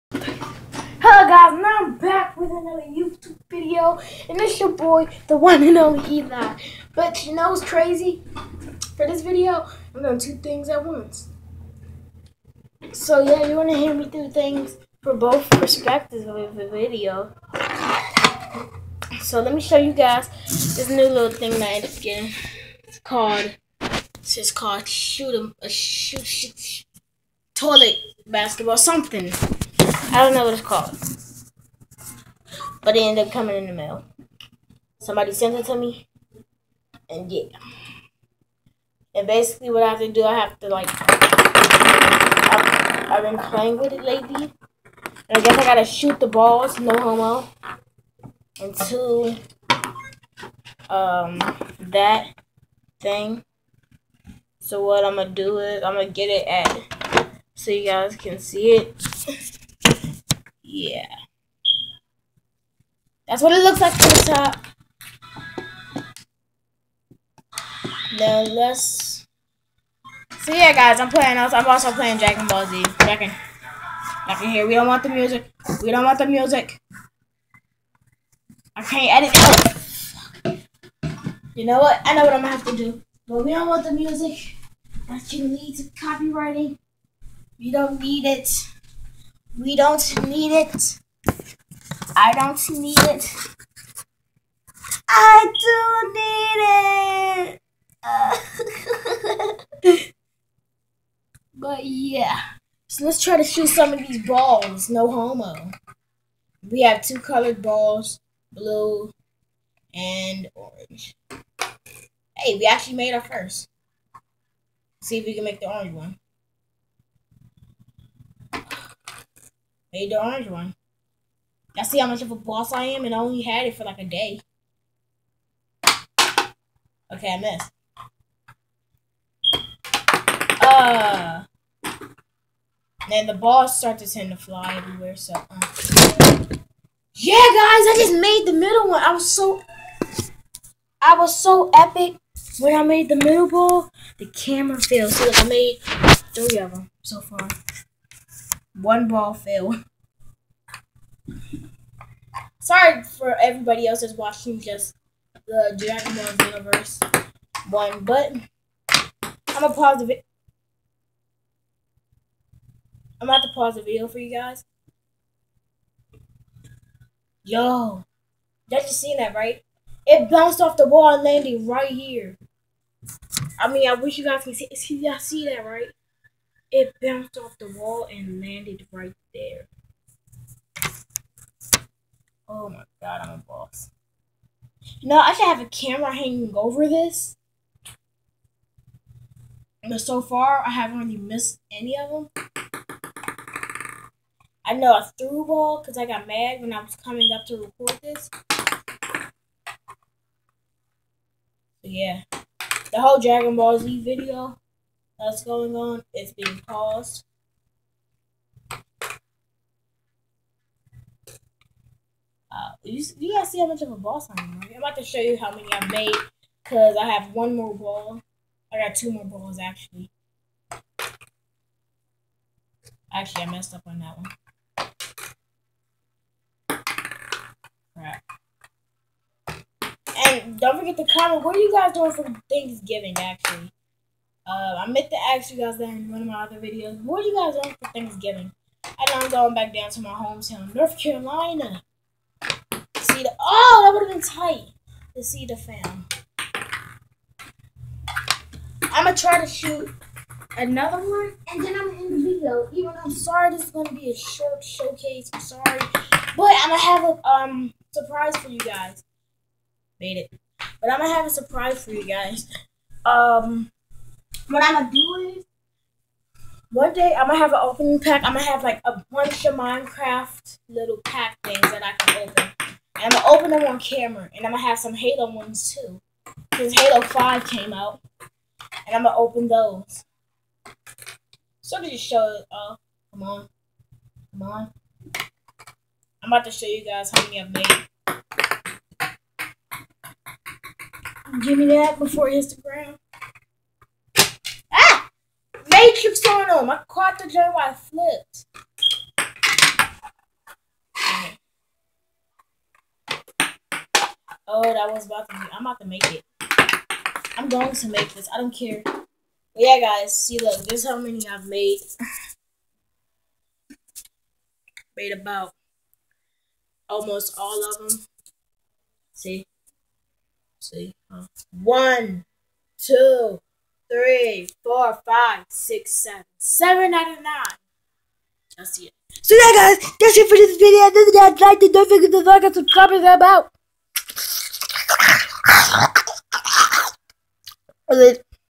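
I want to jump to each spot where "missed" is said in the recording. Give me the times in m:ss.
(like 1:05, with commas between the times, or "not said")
2:07, 3:11.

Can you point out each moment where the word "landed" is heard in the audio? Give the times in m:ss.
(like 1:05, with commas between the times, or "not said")
2:51, 2:58.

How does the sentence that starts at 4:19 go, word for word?
Made it, but I'm gonna have a surprise for you guys.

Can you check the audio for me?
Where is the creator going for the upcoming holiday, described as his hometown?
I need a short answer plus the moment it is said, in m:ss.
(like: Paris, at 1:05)
North Carolina, at 4:00.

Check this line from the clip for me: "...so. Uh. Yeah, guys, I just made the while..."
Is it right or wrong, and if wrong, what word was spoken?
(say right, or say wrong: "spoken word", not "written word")
wrong: "middle", not "while".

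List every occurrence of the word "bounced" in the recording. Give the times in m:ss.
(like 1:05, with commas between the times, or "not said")
2:50, 2:57.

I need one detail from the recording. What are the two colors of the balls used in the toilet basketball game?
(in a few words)
Blue and orange.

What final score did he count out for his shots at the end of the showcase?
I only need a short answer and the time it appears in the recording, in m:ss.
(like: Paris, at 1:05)
7 out of 9, at 5:26.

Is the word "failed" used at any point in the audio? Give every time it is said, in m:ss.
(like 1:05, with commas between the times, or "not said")
2:24, 2:29.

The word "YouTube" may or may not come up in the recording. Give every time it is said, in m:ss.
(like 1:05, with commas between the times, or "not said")
0:02.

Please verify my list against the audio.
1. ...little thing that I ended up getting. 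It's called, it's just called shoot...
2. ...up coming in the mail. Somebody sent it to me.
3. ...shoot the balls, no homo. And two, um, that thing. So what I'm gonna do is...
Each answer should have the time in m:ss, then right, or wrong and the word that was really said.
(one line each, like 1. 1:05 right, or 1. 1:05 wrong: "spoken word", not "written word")
1. 0:21 right
2. 0:33 right
3. 0:45 right.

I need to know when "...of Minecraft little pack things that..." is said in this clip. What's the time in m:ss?
4:29.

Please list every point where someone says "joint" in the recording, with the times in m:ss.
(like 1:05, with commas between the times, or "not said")
4:57.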